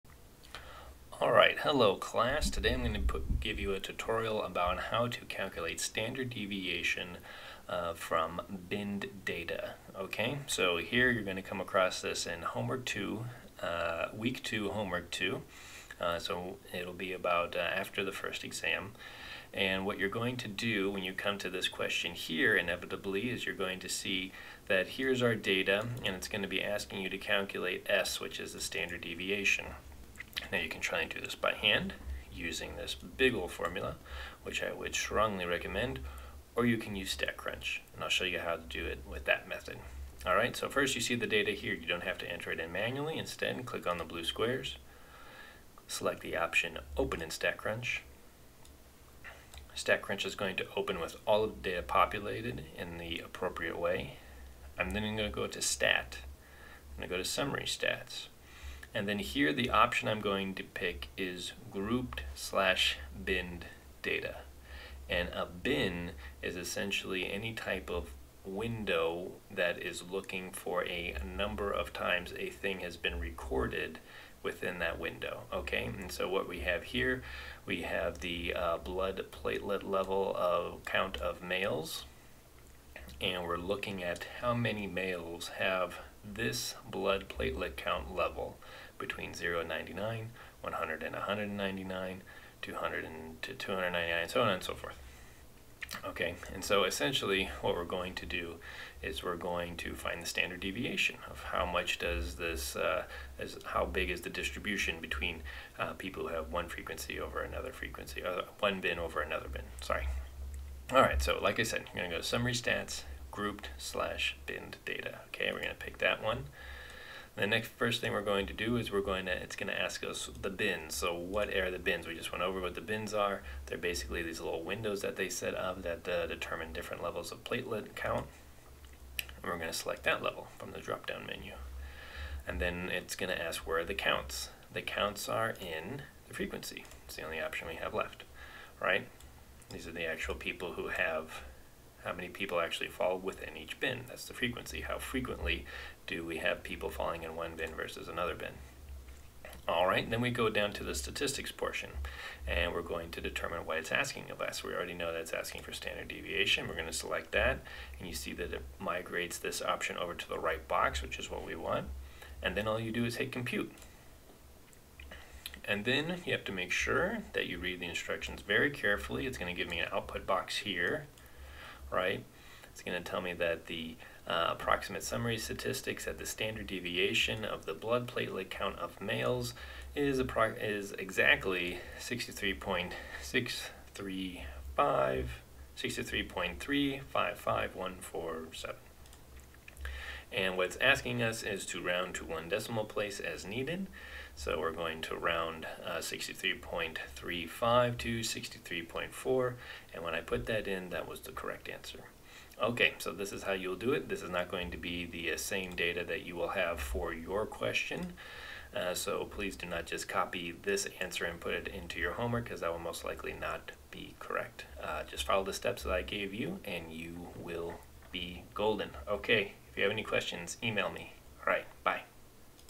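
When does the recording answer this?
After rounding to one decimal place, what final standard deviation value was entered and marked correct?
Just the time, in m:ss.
3:18.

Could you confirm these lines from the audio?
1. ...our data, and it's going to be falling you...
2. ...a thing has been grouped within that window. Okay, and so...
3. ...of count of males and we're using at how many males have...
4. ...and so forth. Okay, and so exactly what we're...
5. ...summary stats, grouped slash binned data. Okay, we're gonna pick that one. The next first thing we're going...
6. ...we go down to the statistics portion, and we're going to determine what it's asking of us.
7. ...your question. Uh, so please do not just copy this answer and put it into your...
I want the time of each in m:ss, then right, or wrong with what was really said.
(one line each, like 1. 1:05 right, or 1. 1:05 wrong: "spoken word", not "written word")
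1. 0:25 wrong: "asking", not "falling"
2. 1:12 wrong: "recorded", not "grouped"
3. 1:20 wrong: "looking", not "using"
4. 1:34 wrong: "essentially", not "exactly"
5. 1:52 right
6. 2:30 right
7. 3:27 right.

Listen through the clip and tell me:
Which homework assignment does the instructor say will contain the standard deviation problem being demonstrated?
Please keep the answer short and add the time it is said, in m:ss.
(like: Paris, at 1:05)
Homework 2, at 0:14.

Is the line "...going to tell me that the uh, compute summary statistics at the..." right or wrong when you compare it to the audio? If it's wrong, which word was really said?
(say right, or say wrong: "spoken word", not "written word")
wrong: "approximate", not "compute".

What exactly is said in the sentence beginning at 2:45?
And then you have to make sure that you read the instructions very carefully.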